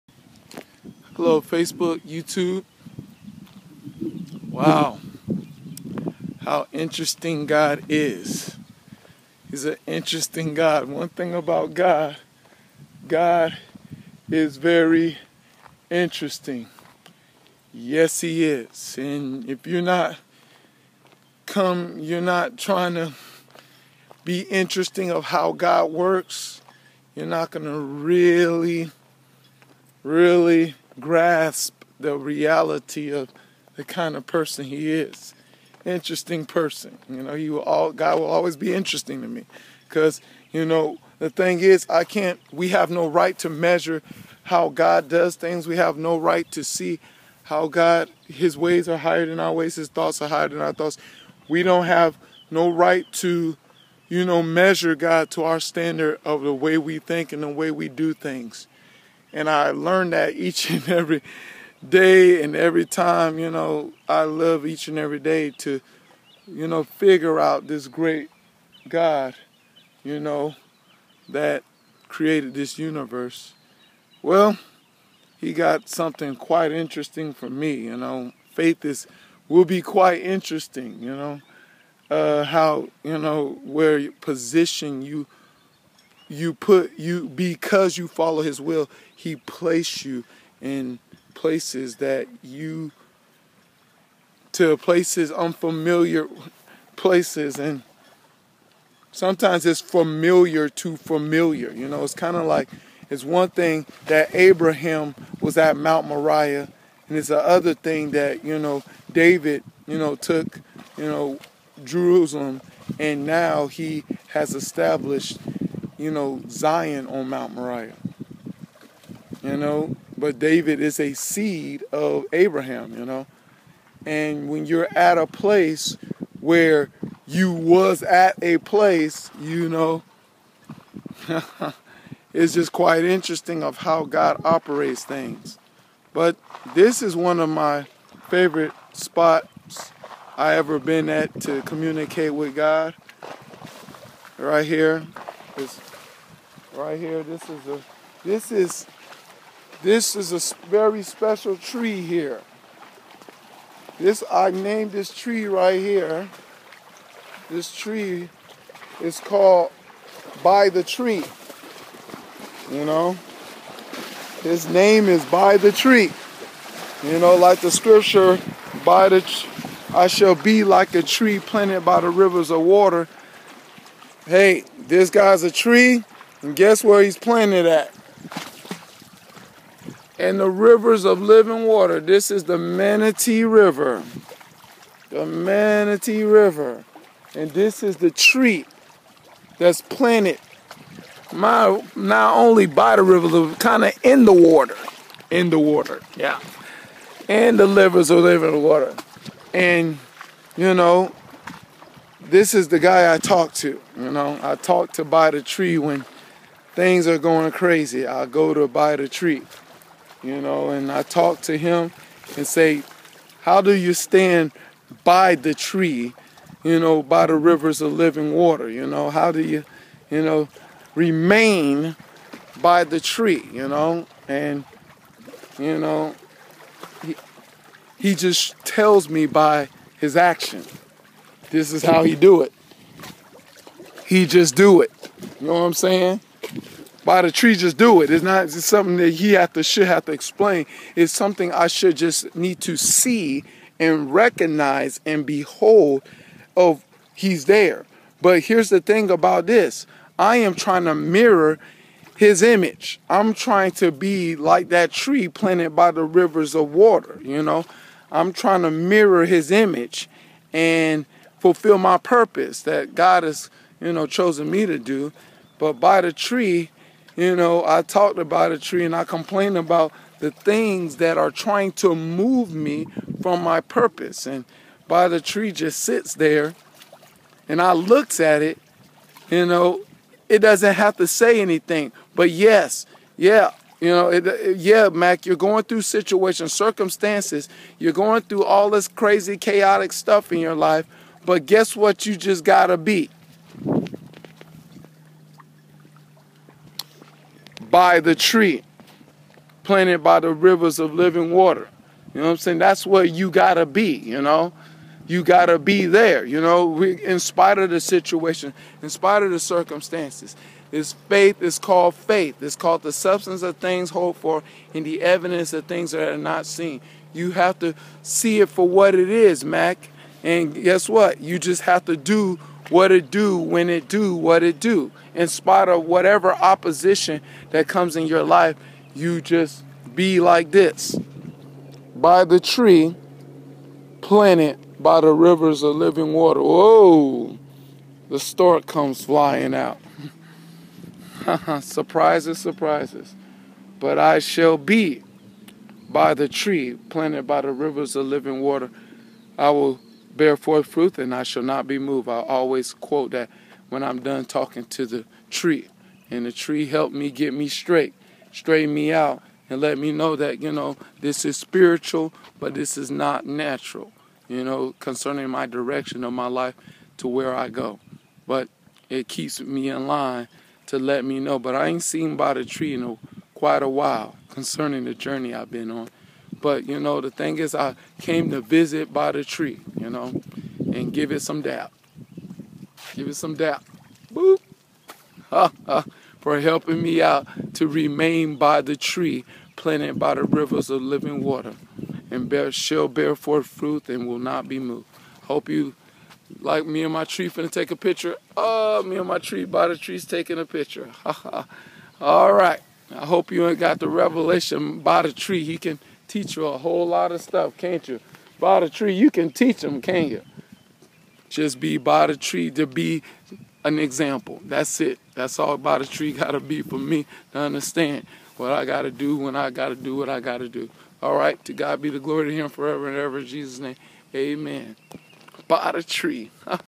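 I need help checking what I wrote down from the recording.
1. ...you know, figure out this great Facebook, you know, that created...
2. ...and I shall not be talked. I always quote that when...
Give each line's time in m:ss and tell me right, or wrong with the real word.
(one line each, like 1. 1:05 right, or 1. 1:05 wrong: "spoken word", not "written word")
1. 1:06 wrong: "God", not "Facebook"
2. 5:50 wrong: "moved", not "talked".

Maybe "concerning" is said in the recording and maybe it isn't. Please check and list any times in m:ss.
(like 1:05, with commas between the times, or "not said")
6:04, 6:14.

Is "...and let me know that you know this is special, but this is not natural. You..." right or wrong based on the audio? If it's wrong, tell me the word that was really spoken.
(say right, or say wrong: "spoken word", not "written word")
wrong: "spiritual", not "special".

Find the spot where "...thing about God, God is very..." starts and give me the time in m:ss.
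0:11.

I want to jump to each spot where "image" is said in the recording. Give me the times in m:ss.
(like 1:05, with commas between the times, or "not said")
4:12, 4:19.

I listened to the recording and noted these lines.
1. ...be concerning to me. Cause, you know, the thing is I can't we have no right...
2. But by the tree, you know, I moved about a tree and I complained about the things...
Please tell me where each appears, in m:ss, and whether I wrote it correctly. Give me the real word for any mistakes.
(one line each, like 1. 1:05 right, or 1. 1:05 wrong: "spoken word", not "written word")
1. 0:38 wrong: "interesting", not "concerning"
2. 4:25 wrong: "talked", not "moved".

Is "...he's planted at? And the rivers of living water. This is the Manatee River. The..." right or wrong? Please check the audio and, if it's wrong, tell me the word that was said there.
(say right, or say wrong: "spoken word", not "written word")
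right.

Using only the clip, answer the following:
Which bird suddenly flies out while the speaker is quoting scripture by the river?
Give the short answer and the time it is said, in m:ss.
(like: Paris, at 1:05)
stork, at 5:38.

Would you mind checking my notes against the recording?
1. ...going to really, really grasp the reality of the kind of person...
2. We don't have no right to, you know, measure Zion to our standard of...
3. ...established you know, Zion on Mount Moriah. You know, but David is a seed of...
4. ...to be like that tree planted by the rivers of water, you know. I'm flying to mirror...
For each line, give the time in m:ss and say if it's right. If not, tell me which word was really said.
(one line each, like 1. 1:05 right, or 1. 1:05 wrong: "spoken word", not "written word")
1. 0:27 right
2. 0:51 wrong: "God", not "Zion"
3. 1:54 right
4. 4:13 wrong: "trying", not "flying".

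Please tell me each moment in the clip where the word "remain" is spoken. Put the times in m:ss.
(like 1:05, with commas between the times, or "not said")
3:40, 6:27.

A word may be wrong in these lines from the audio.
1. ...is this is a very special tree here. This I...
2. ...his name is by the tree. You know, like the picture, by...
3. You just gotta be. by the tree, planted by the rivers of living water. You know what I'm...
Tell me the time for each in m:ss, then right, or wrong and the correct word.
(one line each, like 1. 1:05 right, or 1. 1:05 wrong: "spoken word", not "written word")
1. 2:28 right
2. 2:44 wrong: "scripture", not "picture"
3. 4:52 right.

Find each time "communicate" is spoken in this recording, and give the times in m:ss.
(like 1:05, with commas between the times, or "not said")
2:21.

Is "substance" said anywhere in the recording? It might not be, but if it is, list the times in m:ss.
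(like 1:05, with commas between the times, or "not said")
5:12.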